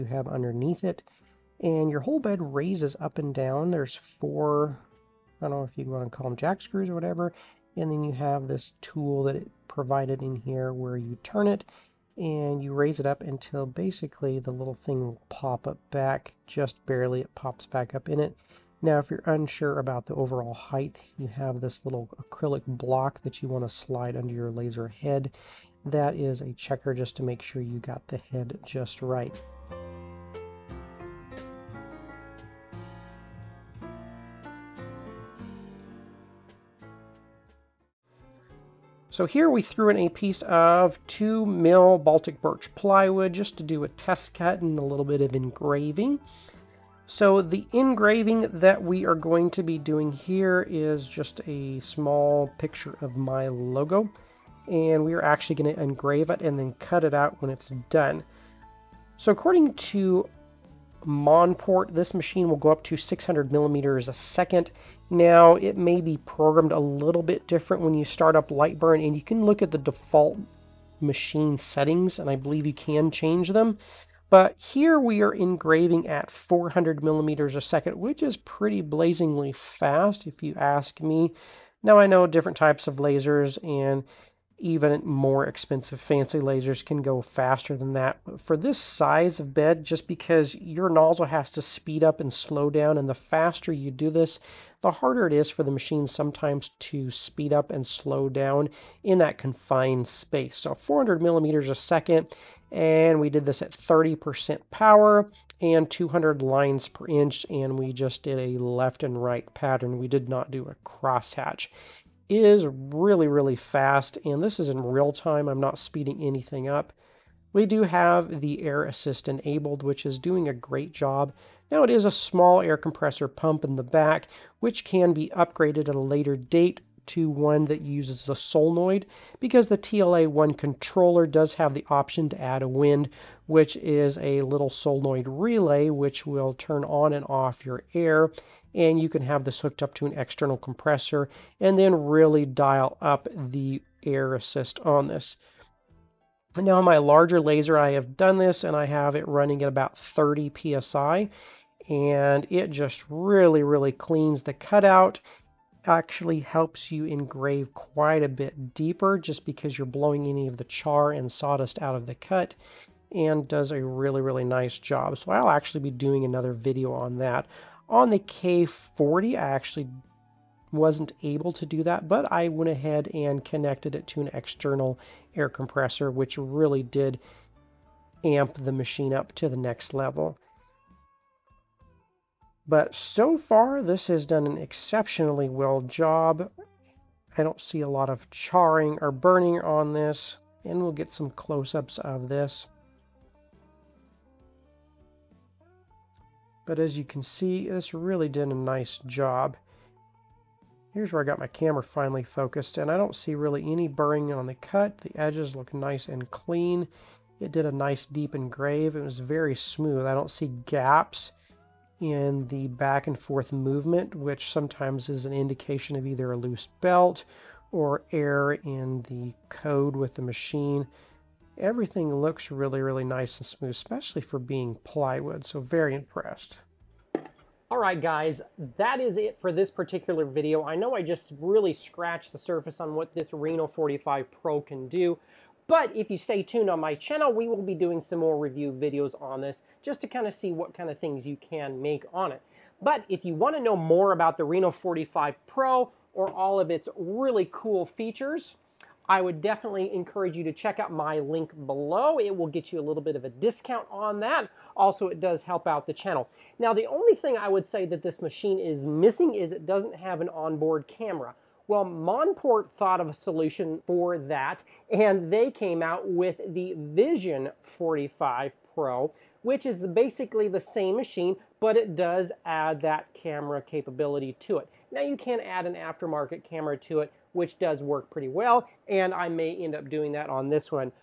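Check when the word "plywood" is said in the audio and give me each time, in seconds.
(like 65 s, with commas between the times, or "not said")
42 s, 224 s.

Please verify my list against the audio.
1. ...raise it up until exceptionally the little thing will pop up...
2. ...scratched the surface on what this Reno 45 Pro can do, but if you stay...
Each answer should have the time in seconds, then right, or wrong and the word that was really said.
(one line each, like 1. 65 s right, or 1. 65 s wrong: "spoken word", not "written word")
1. 12 s wrong: "basically", not "exceptionally"
2. 231 s right.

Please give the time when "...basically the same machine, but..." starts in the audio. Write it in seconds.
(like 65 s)
269 s.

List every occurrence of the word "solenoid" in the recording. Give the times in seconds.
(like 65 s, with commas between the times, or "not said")
128 s, 134 s.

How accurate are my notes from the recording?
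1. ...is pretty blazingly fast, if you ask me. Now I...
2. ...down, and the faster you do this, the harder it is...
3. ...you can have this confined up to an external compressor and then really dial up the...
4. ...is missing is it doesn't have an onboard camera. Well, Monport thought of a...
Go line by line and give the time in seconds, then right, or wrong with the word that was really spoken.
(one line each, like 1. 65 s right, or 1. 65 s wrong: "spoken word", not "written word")
1. 78 s right
2. 92 s right
3. 138 s wrong: "hooked", not "confined"
4. 258 s right.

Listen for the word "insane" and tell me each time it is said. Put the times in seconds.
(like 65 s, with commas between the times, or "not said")
not said.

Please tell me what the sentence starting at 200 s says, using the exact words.
Here's where I got my camera finally focused, and I don't see really any burring on the cut.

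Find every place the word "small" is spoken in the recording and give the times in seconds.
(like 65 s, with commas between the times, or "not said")
51 s, 122 s.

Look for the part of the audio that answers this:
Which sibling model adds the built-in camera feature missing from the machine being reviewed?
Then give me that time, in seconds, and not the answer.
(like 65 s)
266 s.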